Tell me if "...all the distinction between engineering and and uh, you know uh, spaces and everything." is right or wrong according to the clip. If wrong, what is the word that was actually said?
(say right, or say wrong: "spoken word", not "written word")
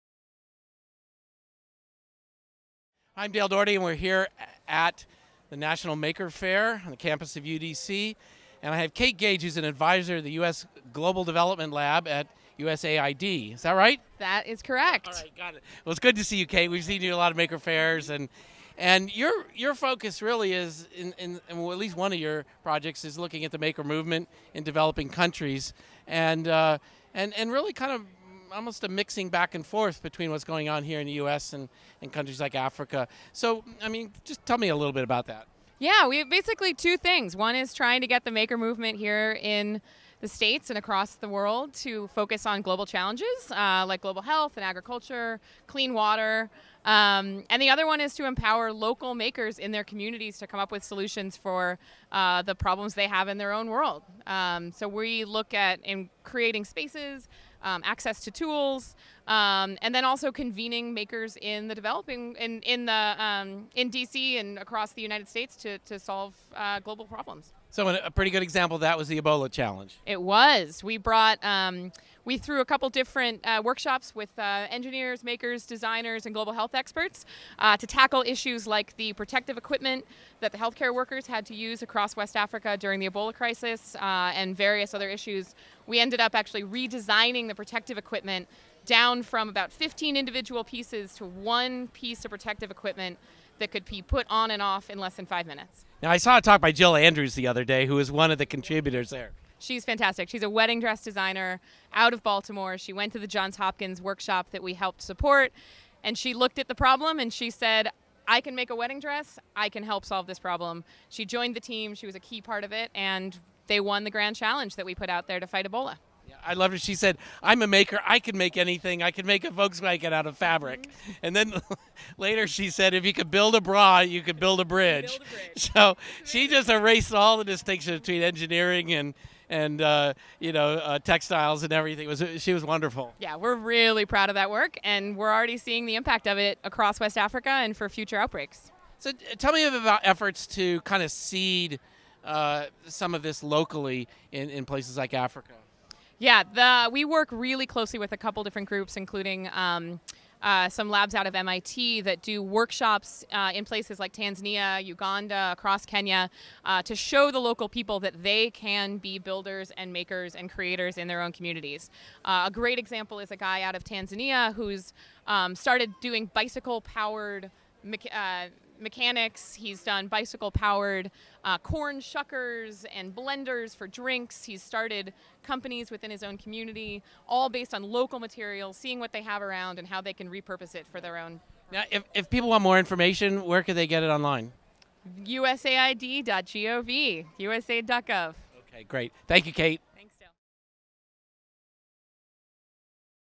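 wrong: "textiles", not "spaces".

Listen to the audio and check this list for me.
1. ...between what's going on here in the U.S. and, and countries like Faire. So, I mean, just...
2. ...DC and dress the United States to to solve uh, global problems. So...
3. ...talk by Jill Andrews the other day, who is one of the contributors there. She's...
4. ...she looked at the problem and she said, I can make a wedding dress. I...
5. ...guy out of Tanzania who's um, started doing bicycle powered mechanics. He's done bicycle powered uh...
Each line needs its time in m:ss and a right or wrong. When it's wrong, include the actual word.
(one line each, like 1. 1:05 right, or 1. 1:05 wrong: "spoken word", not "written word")
1. 0:30 wrong: "Africa", not "Faire"
2. 1:03 wrong: "across", not "dress"
3. 1:36 right
4. 1:46 right
5. 2:43 right.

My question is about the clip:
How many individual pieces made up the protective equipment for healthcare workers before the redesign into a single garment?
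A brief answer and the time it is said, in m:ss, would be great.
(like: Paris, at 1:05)
15, at 1:29.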